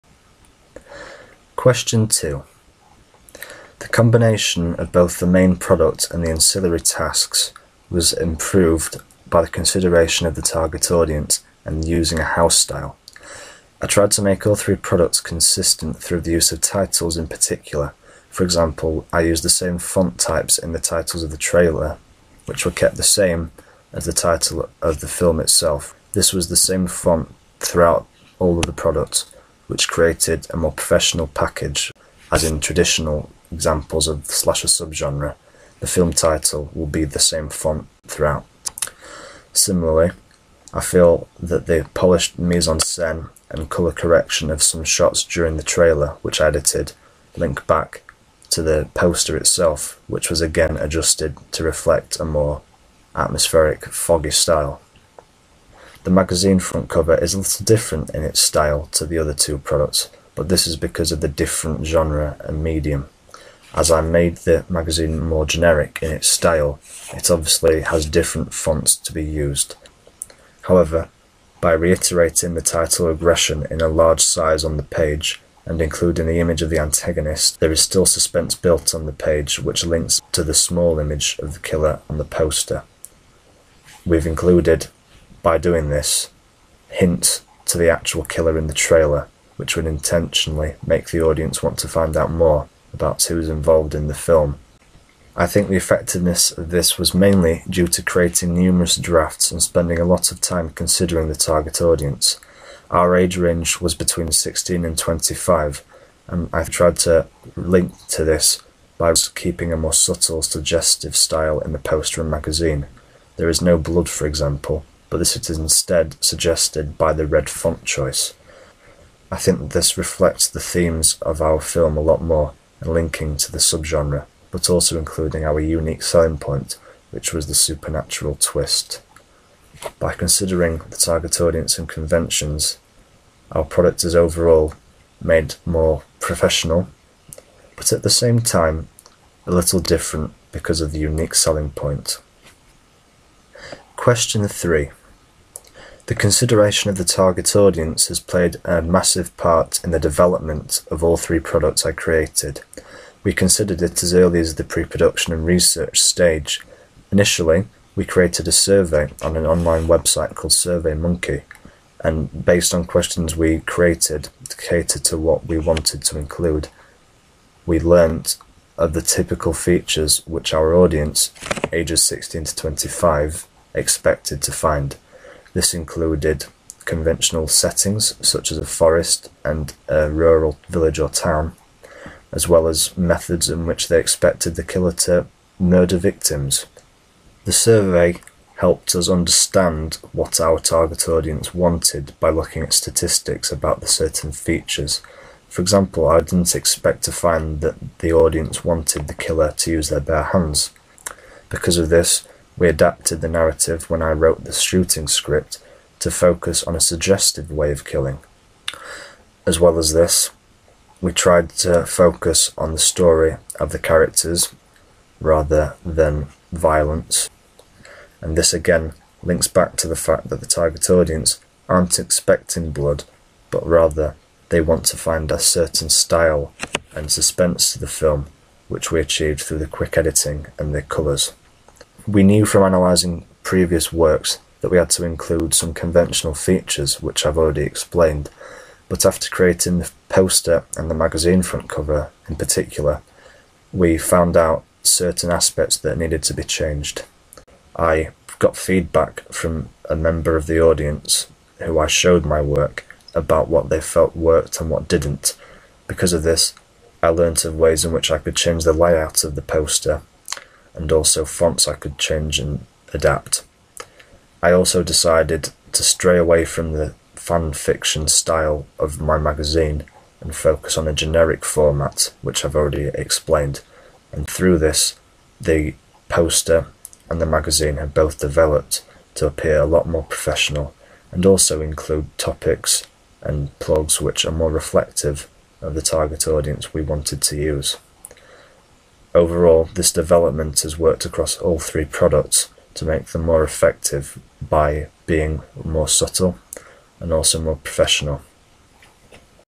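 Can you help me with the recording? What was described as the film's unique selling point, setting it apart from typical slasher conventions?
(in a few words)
the supernatural twist.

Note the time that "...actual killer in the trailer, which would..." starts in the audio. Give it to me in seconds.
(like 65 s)
87 s.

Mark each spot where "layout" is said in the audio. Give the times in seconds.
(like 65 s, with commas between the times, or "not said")
258 s.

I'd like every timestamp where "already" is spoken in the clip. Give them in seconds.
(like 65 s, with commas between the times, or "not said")
237 s, 272 s.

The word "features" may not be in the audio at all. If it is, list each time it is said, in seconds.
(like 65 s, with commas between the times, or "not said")
169 s, 194 s, 236 s.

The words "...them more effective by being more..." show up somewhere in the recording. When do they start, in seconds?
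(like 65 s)
293 s.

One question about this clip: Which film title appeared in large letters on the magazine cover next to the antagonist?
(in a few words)
Regression.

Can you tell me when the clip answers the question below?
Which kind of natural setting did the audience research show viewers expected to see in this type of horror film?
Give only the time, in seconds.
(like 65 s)
178 s.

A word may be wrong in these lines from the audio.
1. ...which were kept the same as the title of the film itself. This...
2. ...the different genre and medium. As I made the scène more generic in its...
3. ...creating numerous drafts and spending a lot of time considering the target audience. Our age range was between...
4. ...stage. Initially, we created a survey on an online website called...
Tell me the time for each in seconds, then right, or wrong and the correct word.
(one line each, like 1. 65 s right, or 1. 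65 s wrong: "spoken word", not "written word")
1. 22 s right
2. 61 s wrong: "magazine", not "scène"
3. 98 s right
4. 156 s right.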